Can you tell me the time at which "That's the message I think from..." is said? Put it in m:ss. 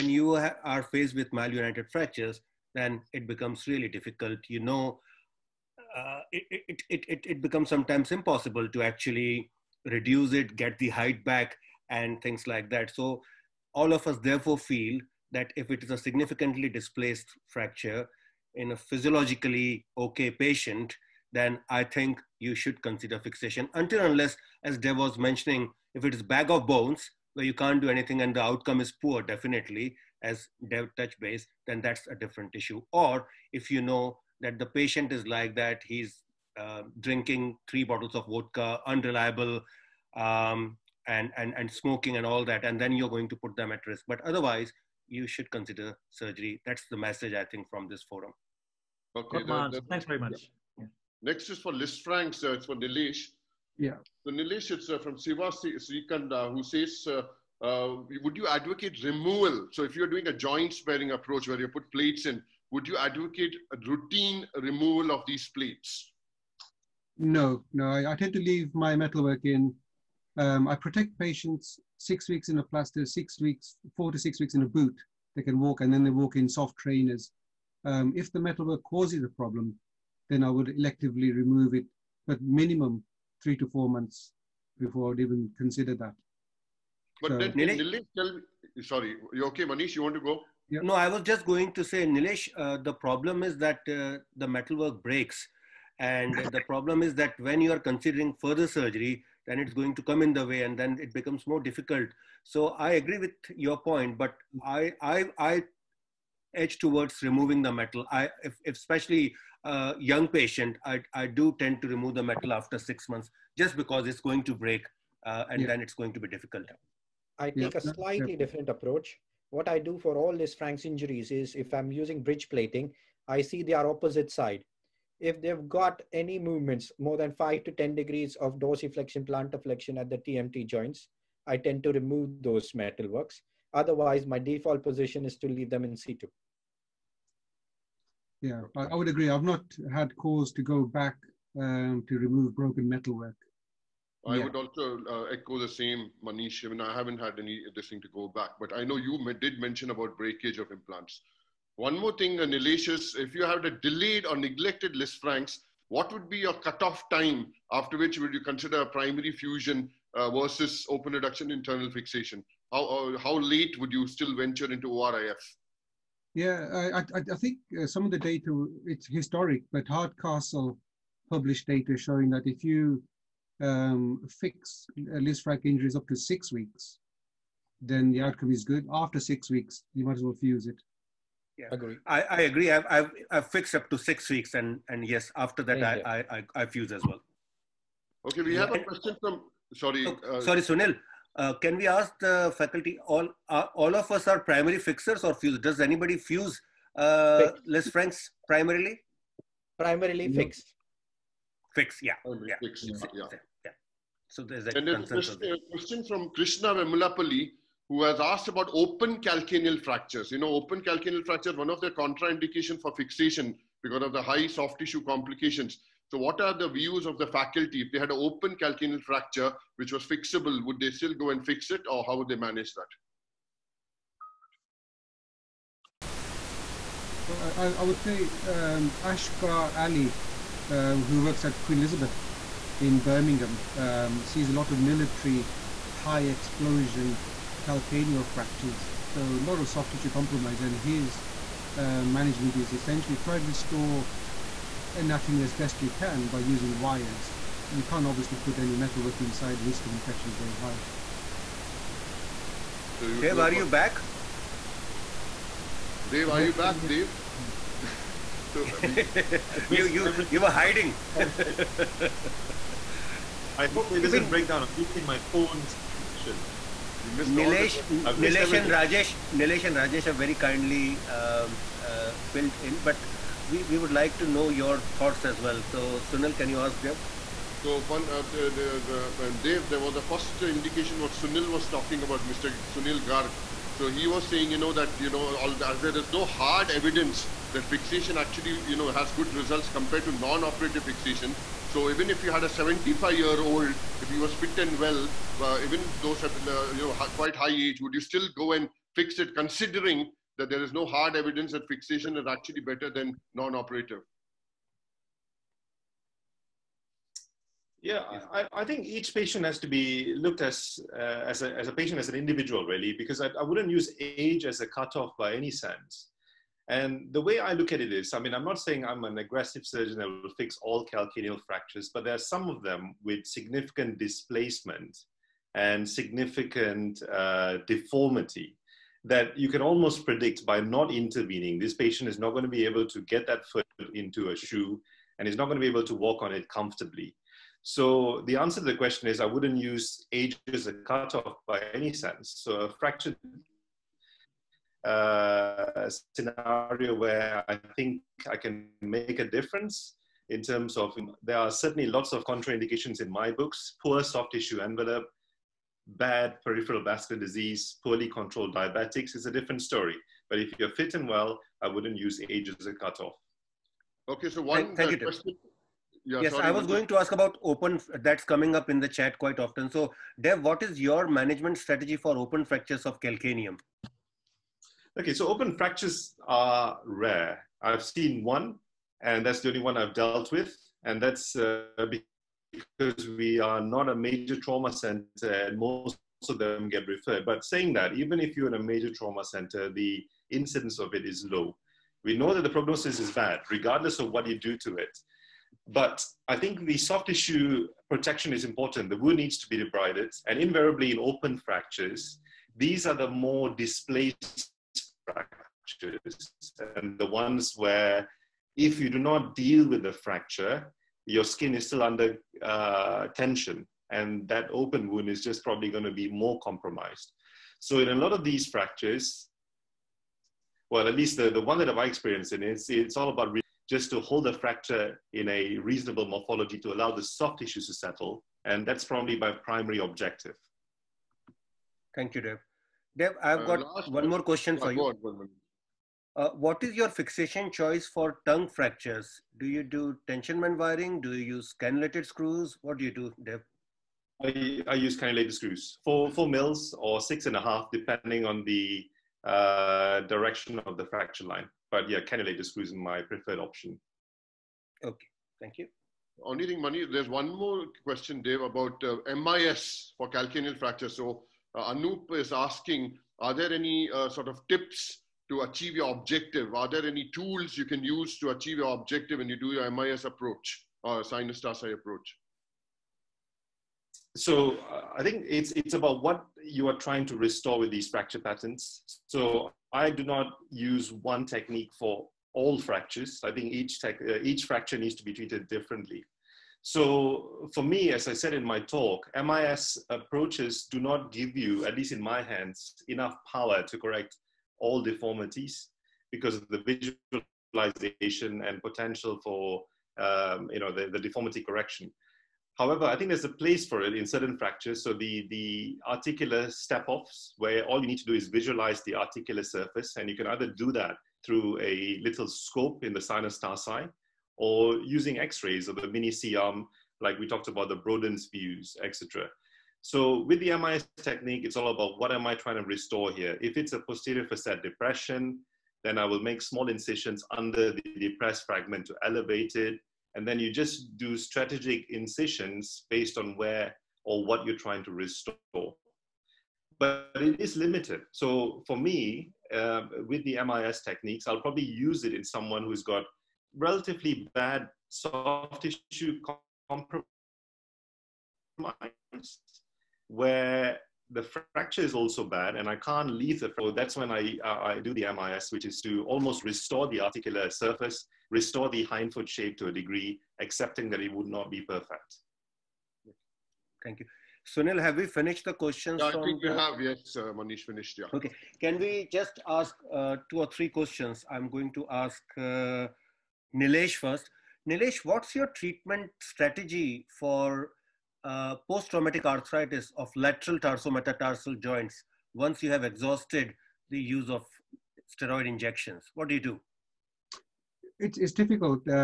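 0:46.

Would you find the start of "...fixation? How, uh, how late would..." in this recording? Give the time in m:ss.
2:41.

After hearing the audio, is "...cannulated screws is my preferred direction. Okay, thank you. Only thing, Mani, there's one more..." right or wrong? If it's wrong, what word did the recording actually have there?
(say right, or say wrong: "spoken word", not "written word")
wrong: "option", not "direction".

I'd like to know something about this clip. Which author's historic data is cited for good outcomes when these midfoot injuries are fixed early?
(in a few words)
Hardcastle.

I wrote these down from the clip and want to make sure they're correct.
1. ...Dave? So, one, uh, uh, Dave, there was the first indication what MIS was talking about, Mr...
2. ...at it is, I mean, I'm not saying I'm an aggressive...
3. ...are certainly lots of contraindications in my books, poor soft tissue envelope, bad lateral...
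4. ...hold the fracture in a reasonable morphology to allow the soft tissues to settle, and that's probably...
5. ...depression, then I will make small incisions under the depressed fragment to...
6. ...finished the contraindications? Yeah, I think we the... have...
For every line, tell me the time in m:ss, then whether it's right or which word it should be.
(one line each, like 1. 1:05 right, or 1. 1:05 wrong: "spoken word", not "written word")
1. 4:36 wrong: "Sunil", not "MIS"
2. 5:17 right
3. 5:51 wrong: "peripheral", not "lateral"
4. 7:03 right
5. 8:44 right
6. 9:25 wrong: "questions", not "contraindications".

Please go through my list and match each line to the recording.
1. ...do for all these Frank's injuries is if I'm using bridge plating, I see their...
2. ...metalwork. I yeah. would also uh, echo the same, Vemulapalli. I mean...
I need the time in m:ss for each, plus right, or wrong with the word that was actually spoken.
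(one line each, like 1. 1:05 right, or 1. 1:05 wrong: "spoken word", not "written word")
1. 1:59 right
2. 2:22 wrong: "Manish", not "Vemulapalli".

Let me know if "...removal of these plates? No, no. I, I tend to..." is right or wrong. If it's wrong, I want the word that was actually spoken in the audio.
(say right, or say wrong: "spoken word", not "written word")
right.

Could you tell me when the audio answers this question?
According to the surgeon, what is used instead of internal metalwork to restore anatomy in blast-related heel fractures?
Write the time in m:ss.
4:06.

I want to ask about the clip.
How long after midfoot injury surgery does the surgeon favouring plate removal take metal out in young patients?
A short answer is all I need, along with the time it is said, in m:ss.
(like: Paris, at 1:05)
6 months, at 1:52.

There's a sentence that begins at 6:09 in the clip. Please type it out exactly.
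So, Dev, what is your management strategy for open fractures of calcaneum?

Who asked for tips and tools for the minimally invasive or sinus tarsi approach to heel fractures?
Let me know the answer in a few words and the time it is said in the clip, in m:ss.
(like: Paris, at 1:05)
Anoop, at 7:41.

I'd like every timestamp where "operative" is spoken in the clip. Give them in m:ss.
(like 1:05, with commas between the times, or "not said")
4:50, 5:03.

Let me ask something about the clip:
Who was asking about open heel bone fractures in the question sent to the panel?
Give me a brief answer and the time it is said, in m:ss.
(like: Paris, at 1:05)
Krishna Vemulapalli, at 3:26.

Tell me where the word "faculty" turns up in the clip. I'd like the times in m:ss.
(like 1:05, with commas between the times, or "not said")
3:12, 3:37.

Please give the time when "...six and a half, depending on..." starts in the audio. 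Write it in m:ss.
7:27.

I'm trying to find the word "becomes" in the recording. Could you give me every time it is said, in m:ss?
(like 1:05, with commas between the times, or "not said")
0:03, 0:07, 1:41.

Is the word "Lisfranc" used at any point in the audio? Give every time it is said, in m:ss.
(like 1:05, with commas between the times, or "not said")
0:51, 2:34, 2:55, 3:17.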